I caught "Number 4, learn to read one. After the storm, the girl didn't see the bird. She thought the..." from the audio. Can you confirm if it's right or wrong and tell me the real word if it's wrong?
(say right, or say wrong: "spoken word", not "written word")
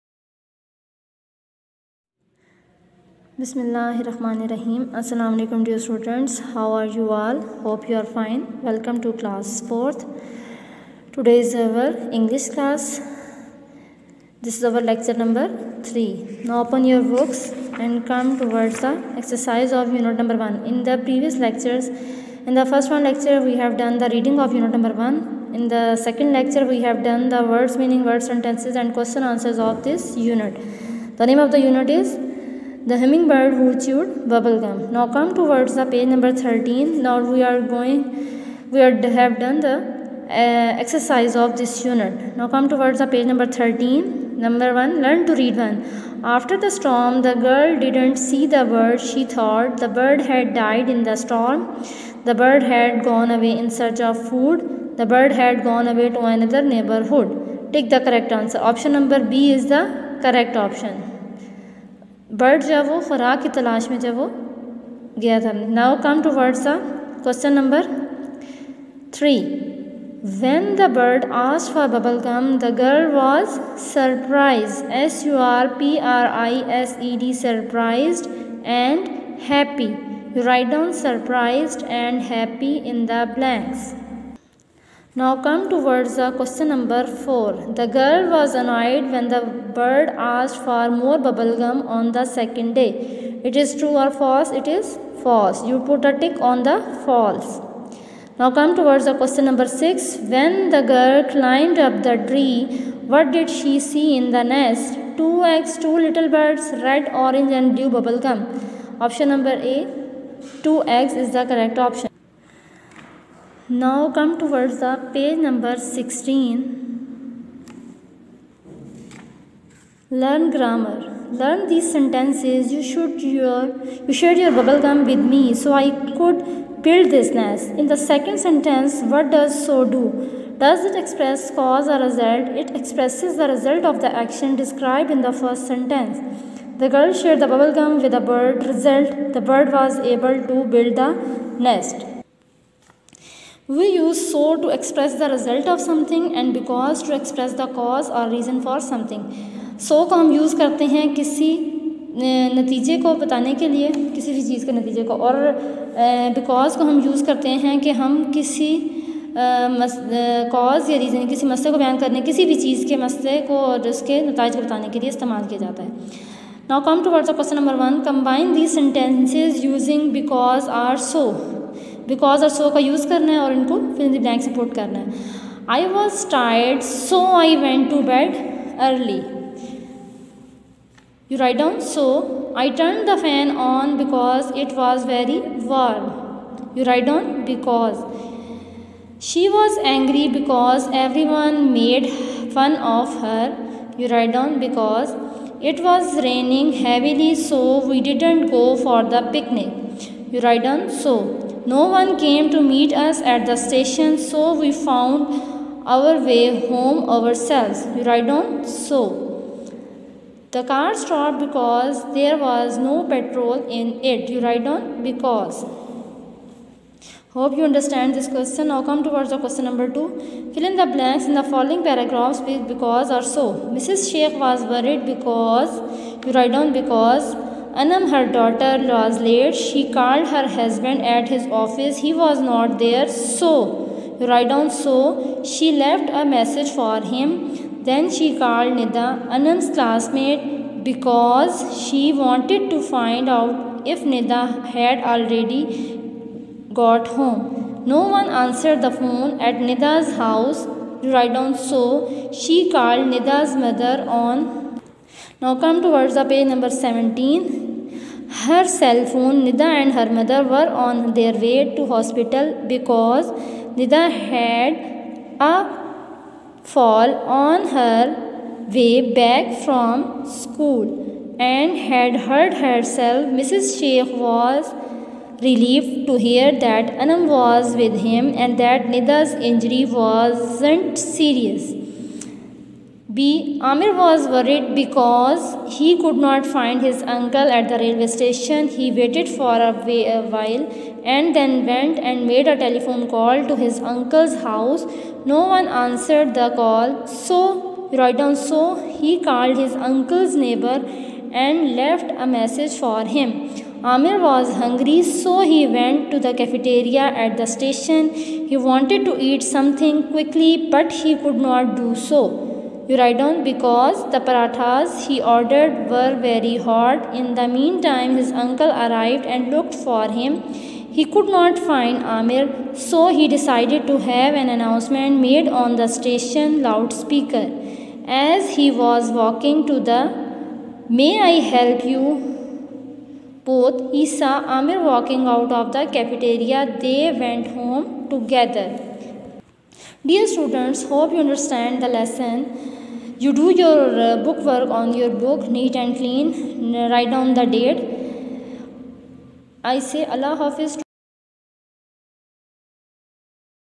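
wrong: "1", not "4".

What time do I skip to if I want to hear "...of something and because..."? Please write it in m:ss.
2:25.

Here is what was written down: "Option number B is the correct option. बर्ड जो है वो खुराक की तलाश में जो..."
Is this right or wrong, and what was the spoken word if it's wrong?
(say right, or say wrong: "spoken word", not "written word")
right.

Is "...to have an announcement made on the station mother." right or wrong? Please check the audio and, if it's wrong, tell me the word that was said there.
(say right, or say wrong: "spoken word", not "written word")
wrong: "loudspeaker", not "mother".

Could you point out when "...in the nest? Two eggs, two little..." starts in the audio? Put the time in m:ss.
1:44.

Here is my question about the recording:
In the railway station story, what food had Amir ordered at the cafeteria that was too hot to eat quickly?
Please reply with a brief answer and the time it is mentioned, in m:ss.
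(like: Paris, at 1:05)
Parathas, at 5:14.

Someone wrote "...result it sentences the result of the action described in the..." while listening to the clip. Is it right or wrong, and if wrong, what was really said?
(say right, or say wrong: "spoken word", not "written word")
wrong: "expresses", not "sentences".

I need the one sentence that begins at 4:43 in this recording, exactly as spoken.
Amir was worried because he could not find his uncle at the railway station.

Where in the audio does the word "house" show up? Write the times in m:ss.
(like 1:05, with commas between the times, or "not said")
4:10, 4:54.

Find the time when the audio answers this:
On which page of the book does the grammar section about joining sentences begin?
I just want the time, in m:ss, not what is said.
1:55.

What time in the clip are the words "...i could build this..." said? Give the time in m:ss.
2:05.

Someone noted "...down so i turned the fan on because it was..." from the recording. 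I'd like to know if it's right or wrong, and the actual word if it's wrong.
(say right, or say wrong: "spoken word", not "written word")
right.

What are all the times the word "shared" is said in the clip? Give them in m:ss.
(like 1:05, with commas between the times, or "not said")
2:04, 2:17.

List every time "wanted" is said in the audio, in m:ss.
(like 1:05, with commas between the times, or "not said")
4:02, 5:08.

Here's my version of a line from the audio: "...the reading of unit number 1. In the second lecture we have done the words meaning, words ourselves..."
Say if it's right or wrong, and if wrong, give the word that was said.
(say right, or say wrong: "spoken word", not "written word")
wrong: "sentences", not "ourselves".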